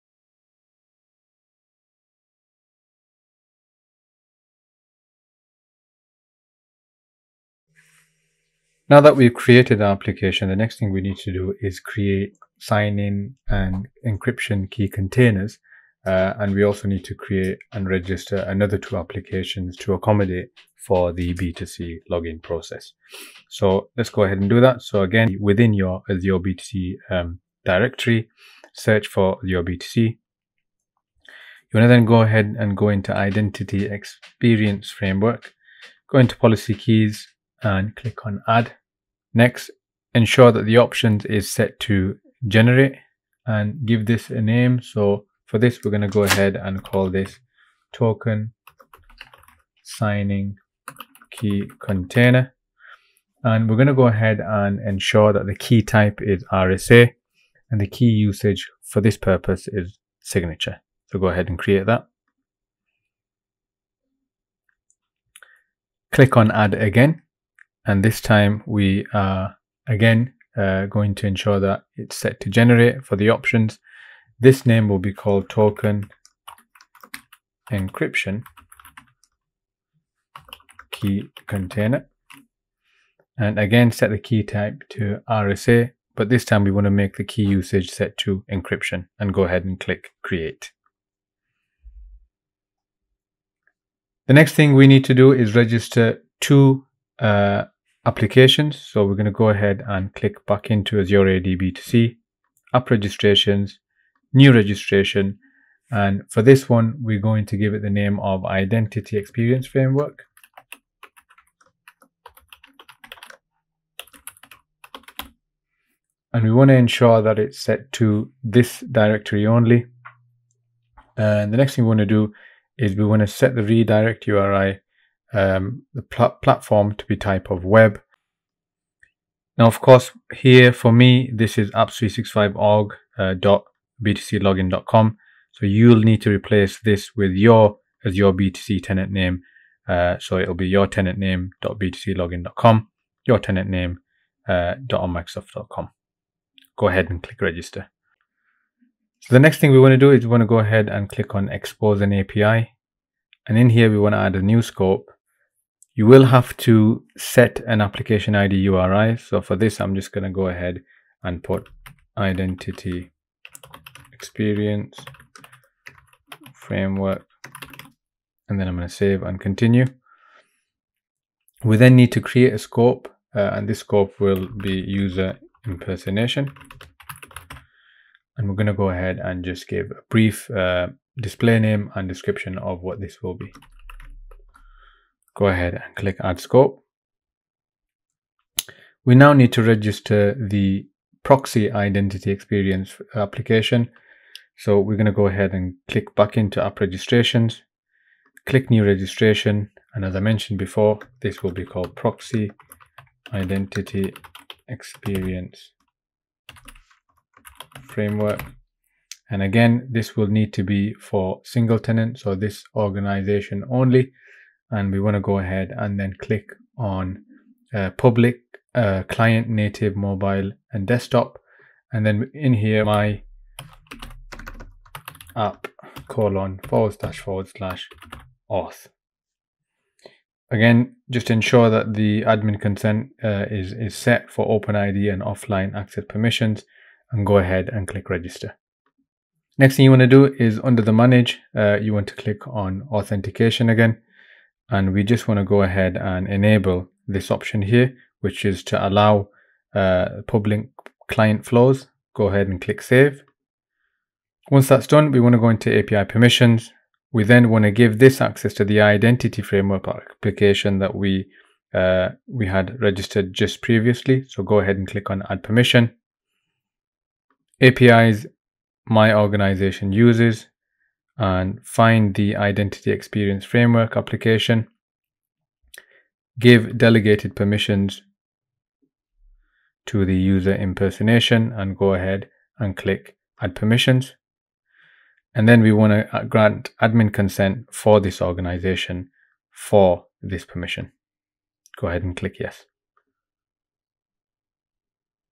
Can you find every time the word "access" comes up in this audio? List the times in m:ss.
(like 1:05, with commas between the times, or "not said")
3:55, 4:18.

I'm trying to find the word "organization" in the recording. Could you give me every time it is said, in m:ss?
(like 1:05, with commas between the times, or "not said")
3:32, 4:29, 4:48.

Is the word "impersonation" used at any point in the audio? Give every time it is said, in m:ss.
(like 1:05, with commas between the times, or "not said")
2:55, 4:40.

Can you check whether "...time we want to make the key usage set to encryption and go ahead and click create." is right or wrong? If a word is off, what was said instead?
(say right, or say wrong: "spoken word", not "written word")
right.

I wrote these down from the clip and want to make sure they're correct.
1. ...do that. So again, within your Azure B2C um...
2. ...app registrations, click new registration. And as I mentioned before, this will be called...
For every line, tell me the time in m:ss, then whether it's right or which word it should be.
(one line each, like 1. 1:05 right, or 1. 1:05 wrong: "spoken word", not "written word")
1. 0:24 right
2. 3:16 right.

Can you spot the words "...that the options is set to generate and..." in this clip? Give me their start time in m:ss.
0:40.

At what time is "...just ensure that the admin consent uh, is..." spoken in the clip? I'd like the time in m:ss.
3:51.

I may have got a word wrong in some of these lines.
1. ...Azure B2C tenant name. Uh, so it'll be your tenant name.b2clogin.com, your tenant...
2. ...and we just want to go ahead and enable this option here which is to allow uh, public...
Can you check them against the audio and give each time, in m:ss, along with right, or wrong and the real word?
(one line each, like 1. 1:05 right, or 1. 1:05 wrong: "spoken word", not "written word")
1. 2:18 right
2. 4:04 right.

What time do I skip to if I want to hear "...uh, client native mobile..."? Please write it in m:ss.
3:38.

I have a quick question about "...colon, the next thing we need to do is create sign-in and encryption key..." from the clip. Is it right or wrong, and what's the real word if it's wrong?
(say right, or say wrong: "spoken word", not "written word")
wrong: "application", not "colon".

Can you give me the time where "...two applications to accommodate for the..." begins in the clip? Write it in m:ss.
0:18.